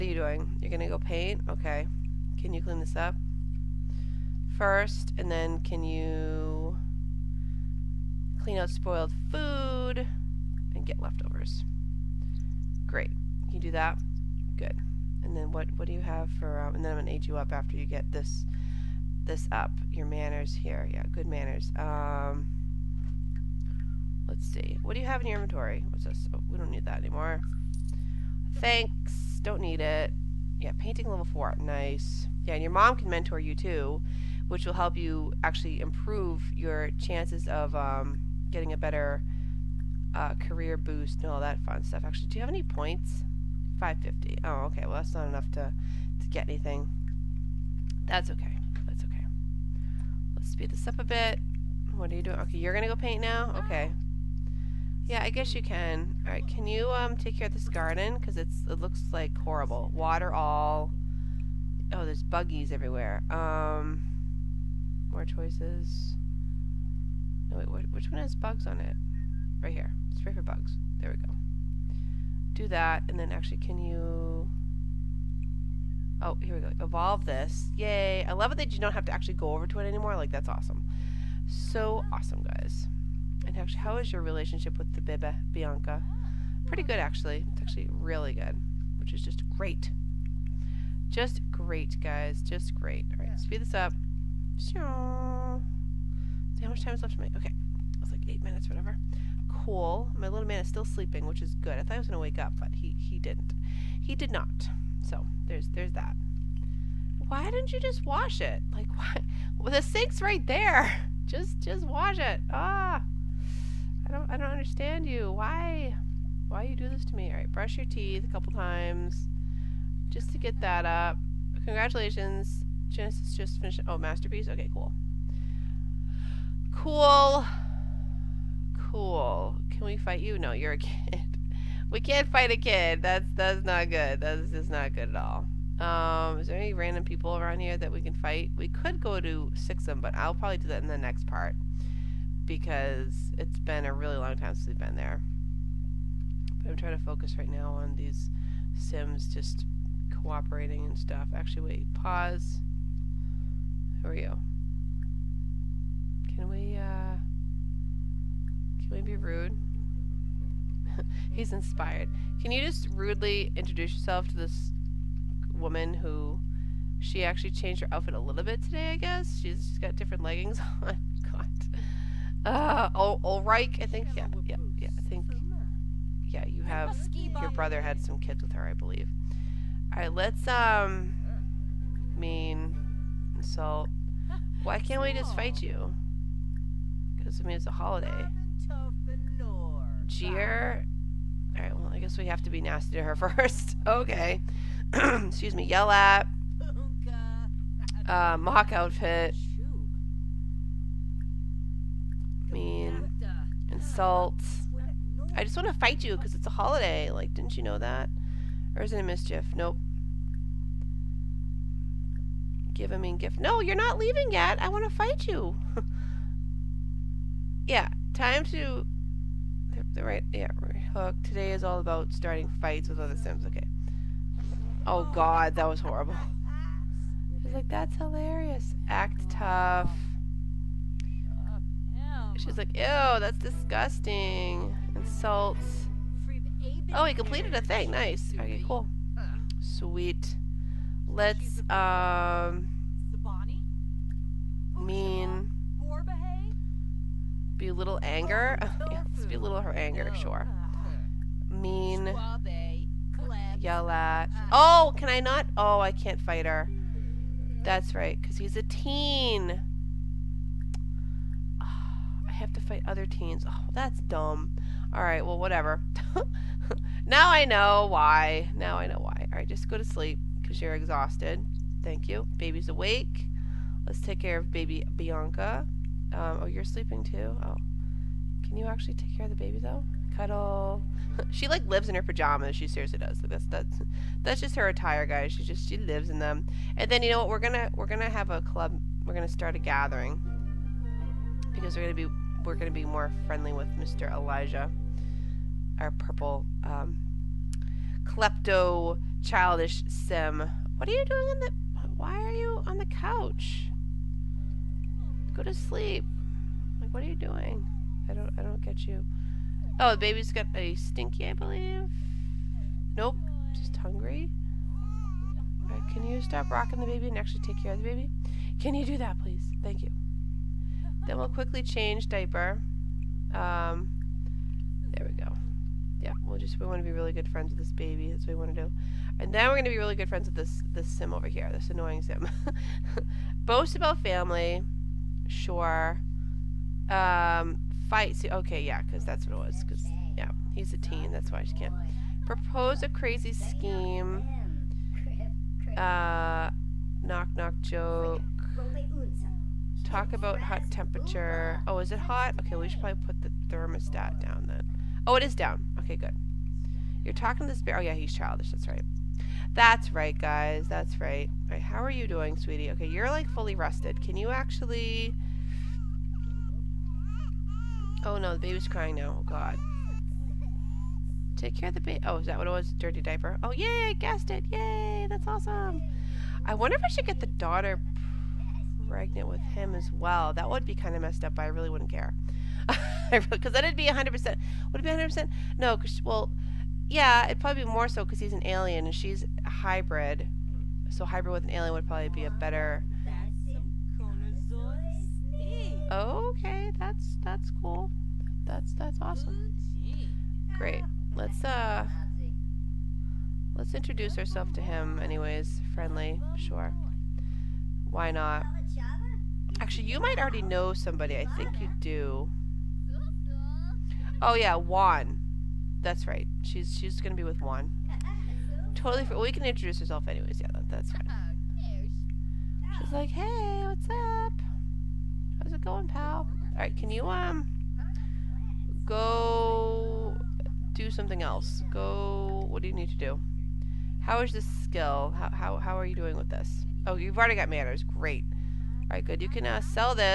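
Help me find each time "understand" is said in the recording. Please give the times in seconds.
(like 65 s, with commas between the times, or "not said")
114 s.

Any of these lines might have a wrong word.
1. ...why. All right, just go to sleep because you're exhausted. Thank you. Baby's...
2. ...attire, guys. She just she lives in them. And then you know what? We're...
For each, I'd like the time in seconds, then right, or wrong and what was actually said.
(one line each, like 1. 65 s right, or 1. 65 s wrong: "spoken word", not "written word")
1. 268 s right
2. 284 s right.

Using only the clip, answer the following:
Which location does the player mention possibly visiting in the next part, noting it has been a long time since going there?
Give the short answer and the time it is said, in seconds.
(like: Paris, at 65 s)
Sixam, at 139 s.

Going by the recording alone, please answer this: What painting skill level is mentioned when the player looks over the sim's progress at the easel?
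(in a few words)
4.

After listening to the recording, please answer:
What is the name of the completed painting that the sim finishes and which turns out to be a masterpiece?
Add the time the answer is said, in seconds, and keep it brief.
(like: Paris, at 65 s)
Genesis, at 122 s.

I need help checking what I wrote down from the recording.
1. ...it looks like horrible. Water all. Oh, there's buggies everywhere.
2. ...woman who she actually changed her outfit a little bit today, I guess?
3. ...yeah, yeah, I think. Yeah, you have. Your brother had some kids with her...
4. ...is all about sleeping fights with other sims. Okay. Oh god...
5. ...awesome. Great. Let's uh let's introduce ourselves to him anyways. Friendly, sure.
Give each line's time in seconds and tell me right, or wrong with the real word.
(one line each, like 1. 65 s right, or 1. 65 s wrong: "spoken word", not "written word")
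1. 58 s right
2. 165 s right
3. 174 s right
4. 221 s wrong: "starting", not "sleeping"
5. 399 s right.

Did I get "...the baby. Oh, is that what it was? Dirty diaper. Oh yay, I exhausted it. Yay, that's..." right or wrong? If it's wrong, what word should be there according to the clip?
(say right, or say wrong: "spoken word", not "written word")
wrong: "guessed", not "exhausted".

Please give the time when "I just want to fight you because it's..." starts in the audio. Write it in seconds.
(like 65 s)
205 s.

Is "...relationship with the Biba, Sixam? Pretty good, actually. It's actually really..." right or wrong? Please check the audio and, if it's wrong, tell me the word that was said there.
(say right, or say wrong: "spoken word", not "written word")
wrong: "Bianca", not "Sixam".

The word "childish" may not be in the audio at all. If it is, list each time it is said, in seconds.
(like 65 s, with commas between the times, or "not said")
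299 s, 358 s.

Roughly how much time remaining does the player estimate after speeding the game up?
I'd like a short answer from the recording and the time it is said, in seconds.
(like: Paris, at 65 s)
8 minutes, at 98 s.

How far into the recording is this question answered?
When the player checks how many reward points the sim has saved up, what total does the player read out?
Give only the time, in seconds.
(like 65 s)
43 s.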